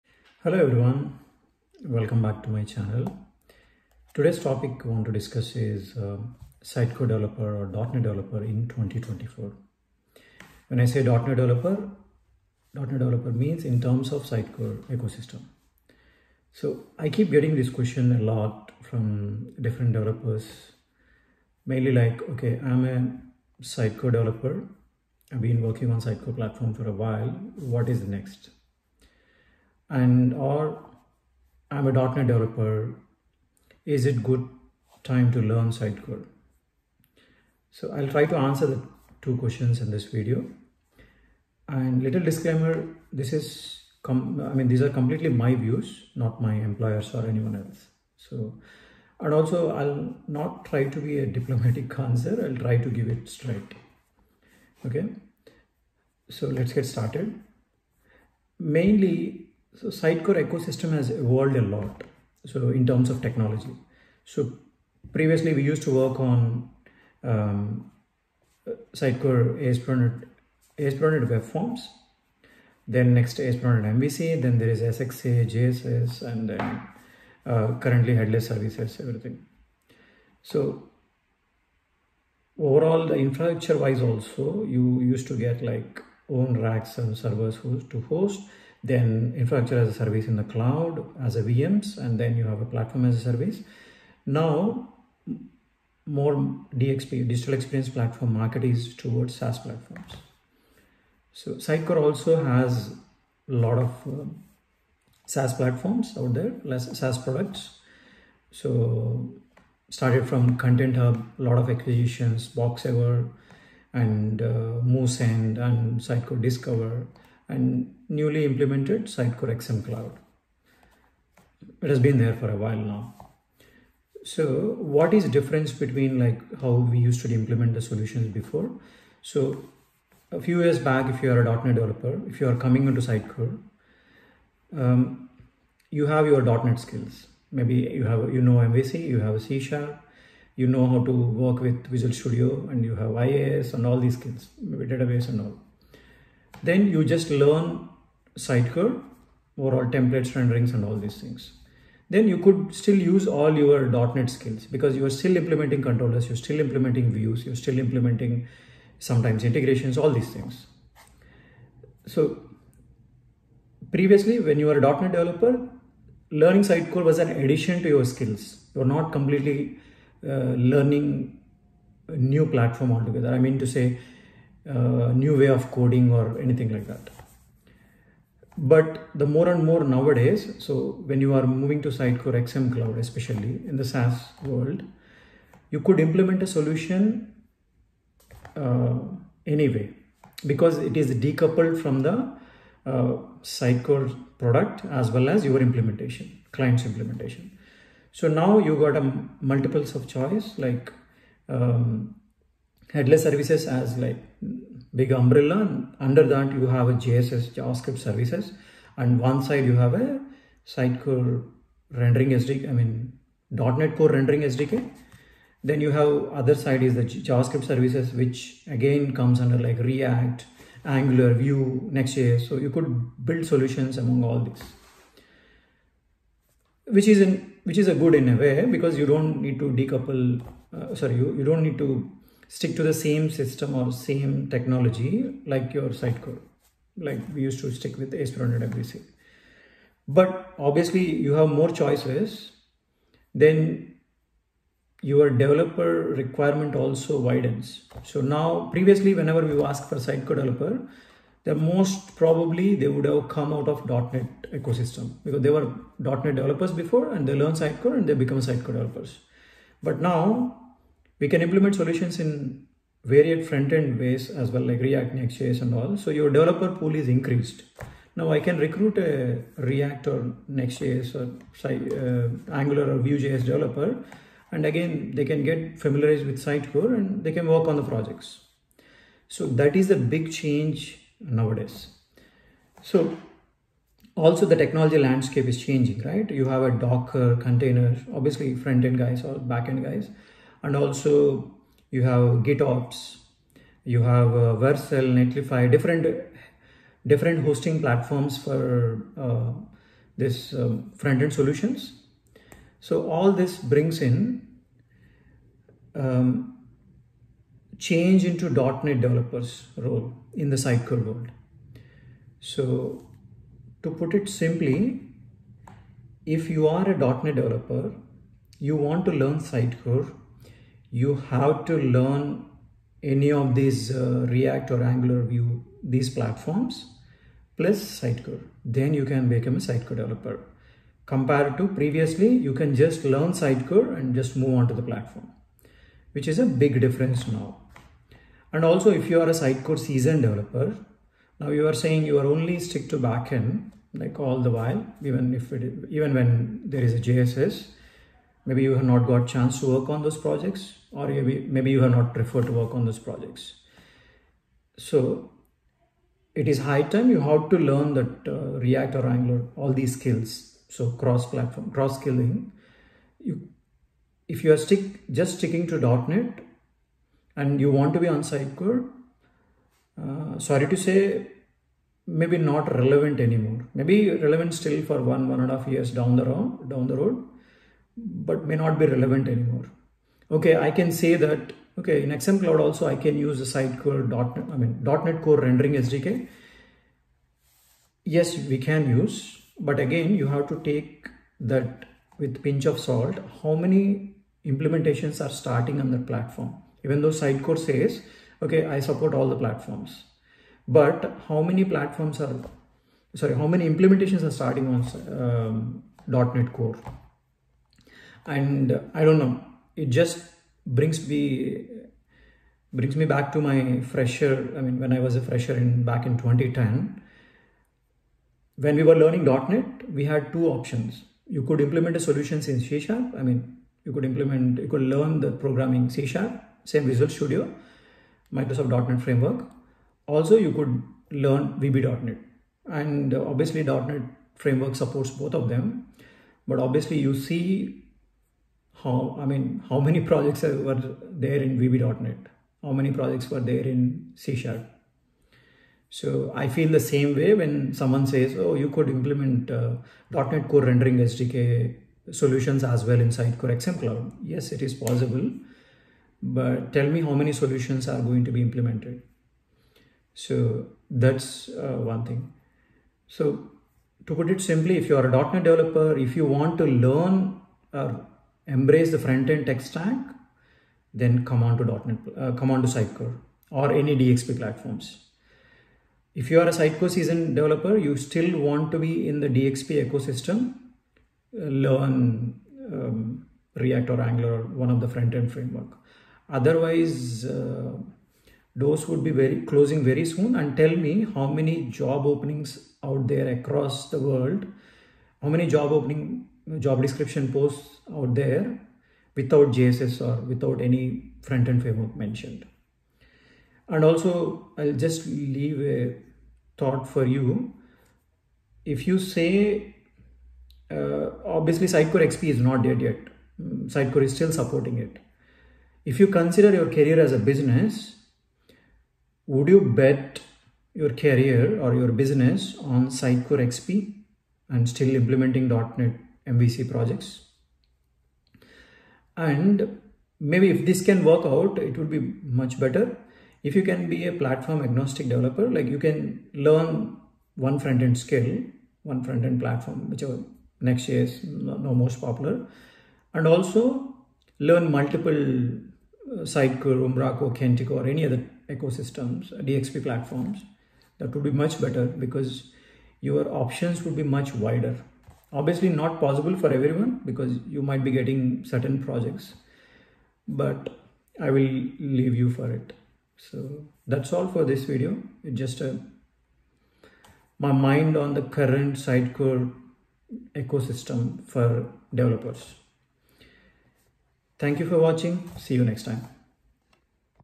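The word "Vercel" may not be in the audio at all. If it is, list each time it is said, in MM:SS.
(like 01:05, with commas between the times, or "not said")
04:54.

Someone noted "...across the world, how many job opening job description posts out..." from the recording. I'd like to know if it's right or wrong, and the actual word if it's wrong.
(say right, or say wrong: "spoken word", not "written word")
right.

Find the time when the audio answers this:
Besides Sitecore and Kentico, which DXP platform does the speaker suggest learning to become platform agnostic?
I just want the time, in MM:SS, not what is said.
09:06.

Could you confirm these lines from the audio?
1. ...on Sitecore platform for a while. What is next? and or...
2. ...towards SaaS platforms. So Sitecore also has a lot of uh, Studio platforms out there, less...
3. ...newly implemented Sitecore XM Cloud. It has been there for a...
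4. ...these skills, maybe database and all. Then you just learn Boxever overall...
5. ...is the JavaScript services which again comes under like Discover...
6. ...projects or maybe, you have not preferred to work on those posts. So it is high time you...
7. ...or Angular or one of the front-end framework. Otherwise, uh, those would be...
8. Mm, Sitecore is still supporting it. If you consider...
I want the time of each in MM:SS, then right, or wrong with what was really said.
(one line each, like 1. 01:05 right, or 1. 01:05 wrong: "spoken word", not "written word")
1. 00:25 right
2. 01:38 wrong: "SaaS", not "Studio"
3. 01:58 right
4. 02:23 wrong: "Sitecore", not "Boxever"
5. 03:36 wrong: "React", not "Discover"
6. 05:50 wrong: "projects", not "posts"
7. 08:03 right
8. 08:33 right.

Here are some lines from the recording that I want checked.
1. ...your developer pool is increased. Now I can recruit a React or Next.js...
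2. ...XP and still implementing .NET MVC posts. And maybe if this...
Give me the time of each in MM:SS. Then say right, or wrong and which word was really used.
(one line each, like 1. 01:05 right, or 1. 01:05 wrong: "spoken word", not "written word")
1. 04:26 right
2. 08:43 wrong: "projects", not "posts".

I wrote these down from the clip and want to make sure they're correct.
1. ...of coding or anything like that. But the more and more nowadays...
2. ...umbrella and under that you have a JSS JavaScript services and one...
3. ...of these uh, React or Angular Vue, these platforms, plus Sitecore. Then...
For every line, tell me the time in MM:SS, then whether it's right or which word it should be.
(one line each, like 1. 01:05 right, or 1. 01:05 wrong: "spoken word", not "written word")
1. 02:55 right
2. 03:25 right
3. 05:23 right.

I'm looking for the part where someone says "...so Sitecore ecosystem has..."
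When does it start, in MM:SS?
00:59.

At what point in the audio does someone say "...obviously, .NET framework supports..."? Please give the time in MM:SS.
07:13.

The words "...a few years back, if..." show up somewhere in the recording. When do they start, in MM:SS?
02:10.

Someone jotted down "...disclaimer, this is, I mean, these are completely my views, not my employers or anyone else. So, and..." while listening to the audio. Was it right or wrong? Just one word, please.
right.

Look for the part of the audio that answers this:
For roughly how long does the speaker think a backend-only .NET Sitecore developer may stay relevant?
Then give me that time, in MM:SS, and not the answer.
06:15.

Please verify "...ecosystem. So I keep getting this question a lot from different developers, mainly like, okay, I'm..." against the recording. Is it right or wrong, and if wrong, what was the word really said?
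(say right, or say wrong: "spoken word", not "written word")
right.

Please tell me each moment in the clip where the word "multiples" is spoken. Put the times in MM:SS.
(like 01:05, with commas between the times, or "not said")
03:19, 09:04.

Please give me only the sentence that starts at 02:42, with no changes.
So previously when you were a .NET developer, learning Sitecore was an addition to your skills.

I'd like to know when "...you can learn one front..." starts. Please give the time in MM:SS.
08:55.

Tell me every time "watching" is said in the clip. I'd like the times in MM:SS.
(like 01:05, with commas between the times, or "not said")
09:34.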